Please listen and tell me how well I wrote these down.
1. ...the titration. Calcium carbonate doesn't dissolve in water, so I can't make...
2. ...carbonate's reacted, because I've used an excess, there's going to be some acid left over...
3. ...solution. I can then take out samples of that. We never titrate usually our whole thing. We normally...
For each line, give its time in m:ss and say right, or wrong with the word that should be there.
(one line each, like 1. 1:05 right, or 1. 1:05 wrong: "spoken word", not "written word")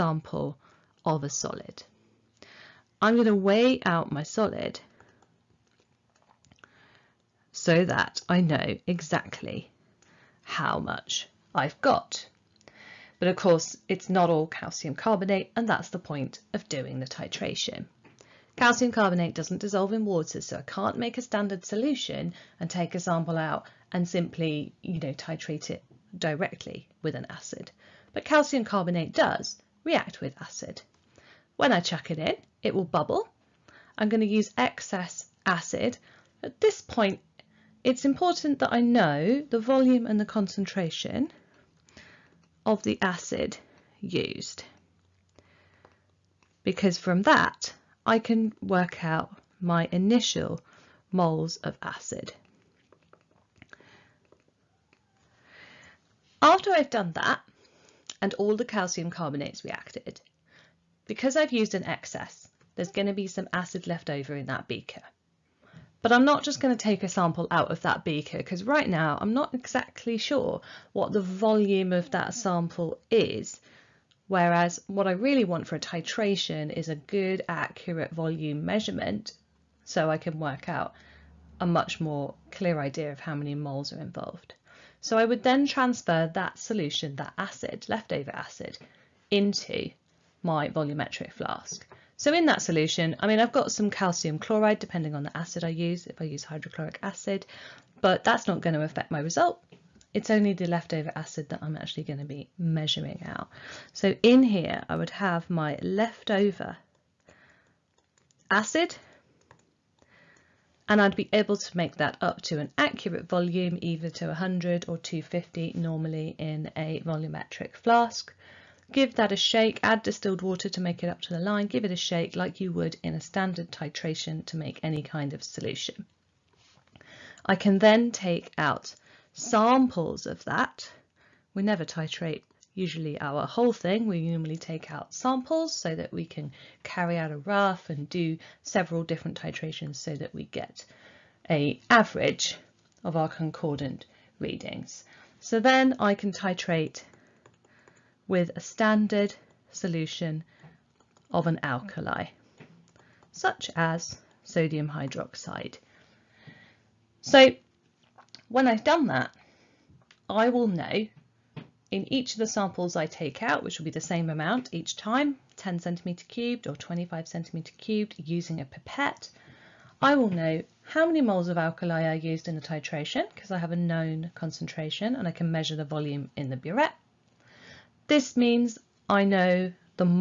1. 0:16 right
2. 0:59 right
3. 2:05 right.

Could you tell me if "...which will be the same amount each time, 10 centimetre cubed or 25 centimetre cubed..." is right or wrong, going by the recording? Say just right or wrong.
right.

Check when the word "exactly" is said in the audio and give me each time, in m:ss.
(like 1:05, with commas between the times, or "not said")
0:08, 1:09.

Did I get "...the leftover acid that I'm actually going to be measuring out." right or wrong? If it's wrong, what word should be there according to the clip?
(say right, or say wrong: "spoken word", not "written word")
right.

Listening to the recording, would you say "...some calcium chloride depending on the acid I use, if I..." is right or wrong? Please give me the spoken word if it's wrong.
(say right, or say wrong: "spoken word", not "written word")
right.